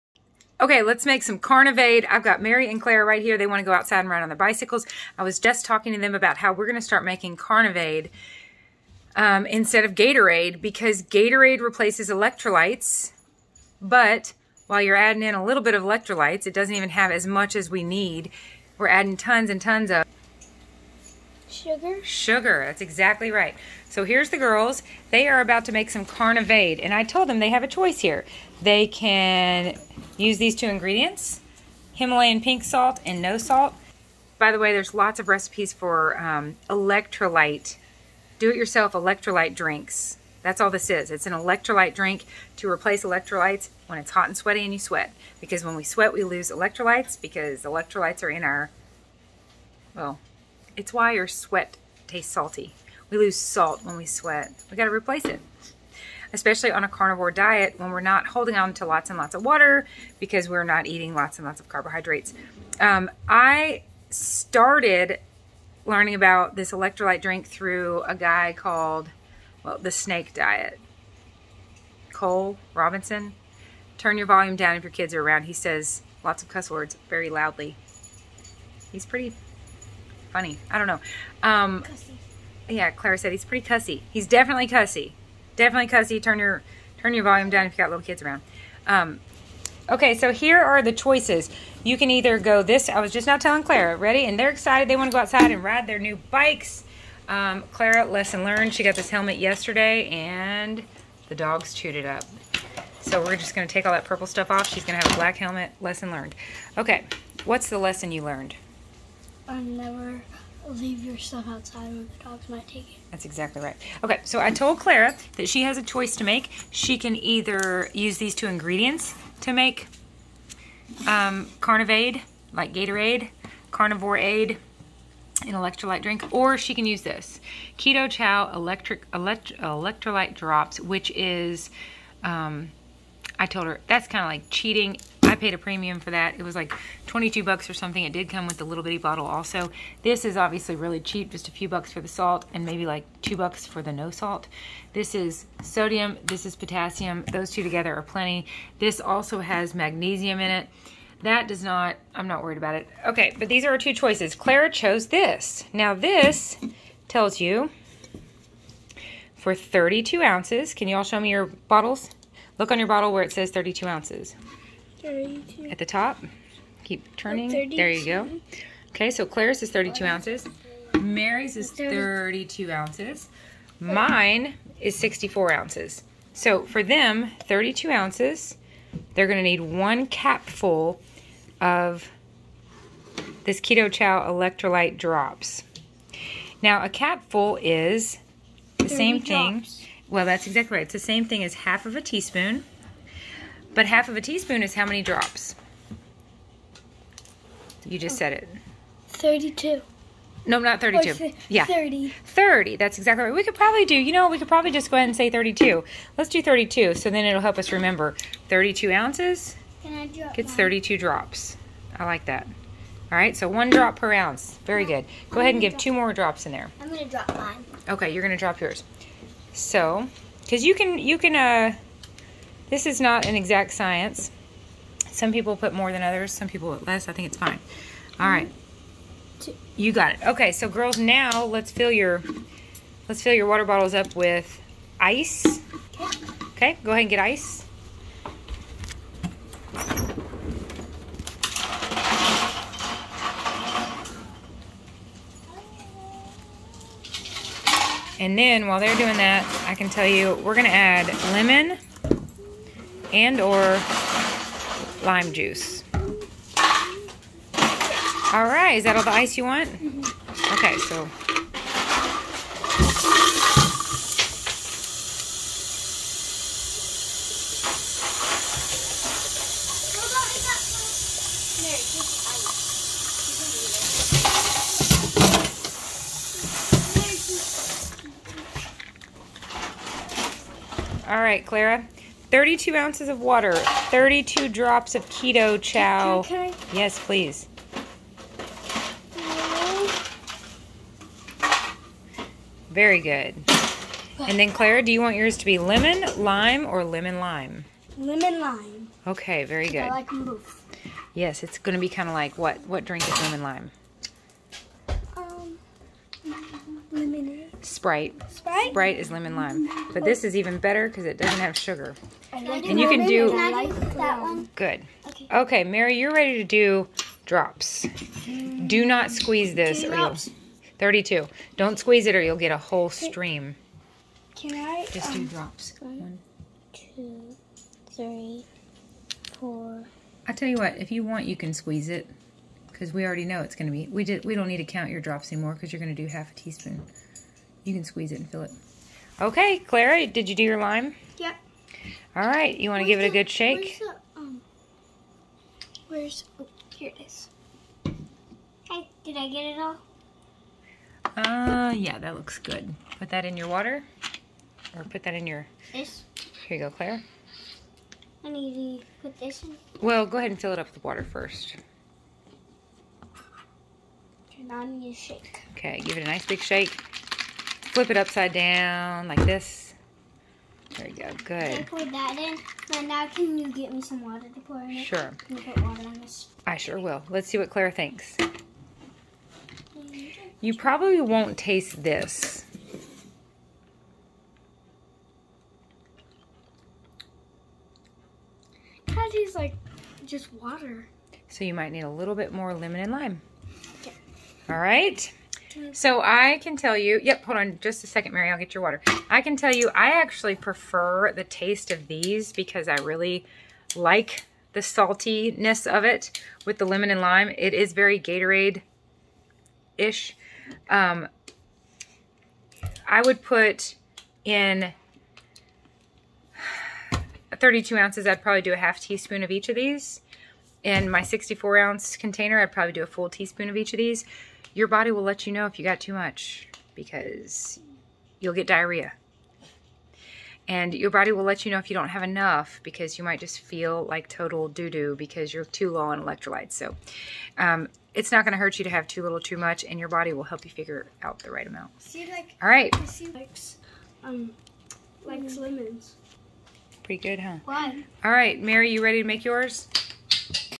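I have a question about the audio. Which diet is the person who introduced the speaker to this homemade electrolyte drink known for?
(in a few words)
The snake diet.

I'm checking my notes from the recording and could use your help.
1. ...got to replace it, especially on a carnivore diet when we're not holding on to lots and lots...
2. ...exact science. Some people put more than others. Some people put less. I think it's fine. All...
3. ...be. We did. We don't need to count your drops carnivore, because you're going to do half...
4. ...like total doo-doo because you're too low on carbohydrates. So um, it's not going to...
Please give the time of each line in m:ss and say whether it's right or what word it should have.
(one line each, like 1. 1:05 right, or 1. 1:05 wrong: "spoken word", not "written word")
1. 0:54 right
2. 3:43 right
3. 5:33 wrong: "anymore", not "carnivore"
4. 7:13 wrong: "electrolytes", not "carbohydrates".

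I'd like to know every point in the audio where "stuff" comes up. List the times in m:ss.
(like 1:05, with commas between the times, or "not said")
1:44, 1:51.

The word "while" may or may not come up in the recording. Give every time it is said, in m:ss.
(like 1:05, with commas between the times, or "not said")
0:14, 4:08.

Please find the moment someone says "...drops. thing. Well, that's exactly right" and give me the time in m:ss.
3:09.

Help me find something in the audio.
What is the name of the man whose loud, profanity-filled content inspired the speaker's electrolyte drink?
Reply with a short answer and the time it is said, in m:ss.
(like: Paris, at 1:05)
Cole Robinson, at 1:12.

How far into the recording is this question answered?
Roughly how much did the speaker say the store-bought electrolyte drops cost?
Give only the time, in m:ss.
2:17.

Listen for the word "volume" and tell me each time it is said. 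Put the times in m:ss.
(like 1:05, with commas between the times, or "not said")
1:14, 1:27.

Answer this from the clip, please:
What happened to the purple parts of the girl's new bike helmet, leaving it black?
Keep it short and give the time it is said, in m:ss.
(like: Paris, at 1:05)
The dogs chewed it, at 1:41.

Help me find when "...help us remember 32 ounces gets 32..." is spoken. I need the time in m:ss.
3:27.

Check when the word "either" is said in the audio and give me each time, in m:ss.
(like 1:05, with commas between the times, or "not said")
1:32, 1:57.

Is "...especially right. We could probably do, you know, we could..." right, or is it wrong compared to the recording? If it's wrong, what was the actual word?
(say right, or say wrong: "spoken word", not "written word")
wrong: "exactly", not "especially".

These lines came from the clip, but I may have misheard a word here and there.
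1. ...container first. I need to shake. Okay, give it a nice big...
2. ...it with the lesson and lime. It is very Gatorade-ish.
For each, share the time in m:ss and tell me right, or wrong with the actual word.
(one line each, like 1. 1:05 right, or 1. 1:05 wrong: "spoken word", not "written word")
1. 6:00 wrong: "water", not "container"
2. 6:45 wrong: "lemon", not "lesson".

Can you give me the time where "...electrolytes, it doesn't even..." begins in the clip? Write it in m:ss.
0:15.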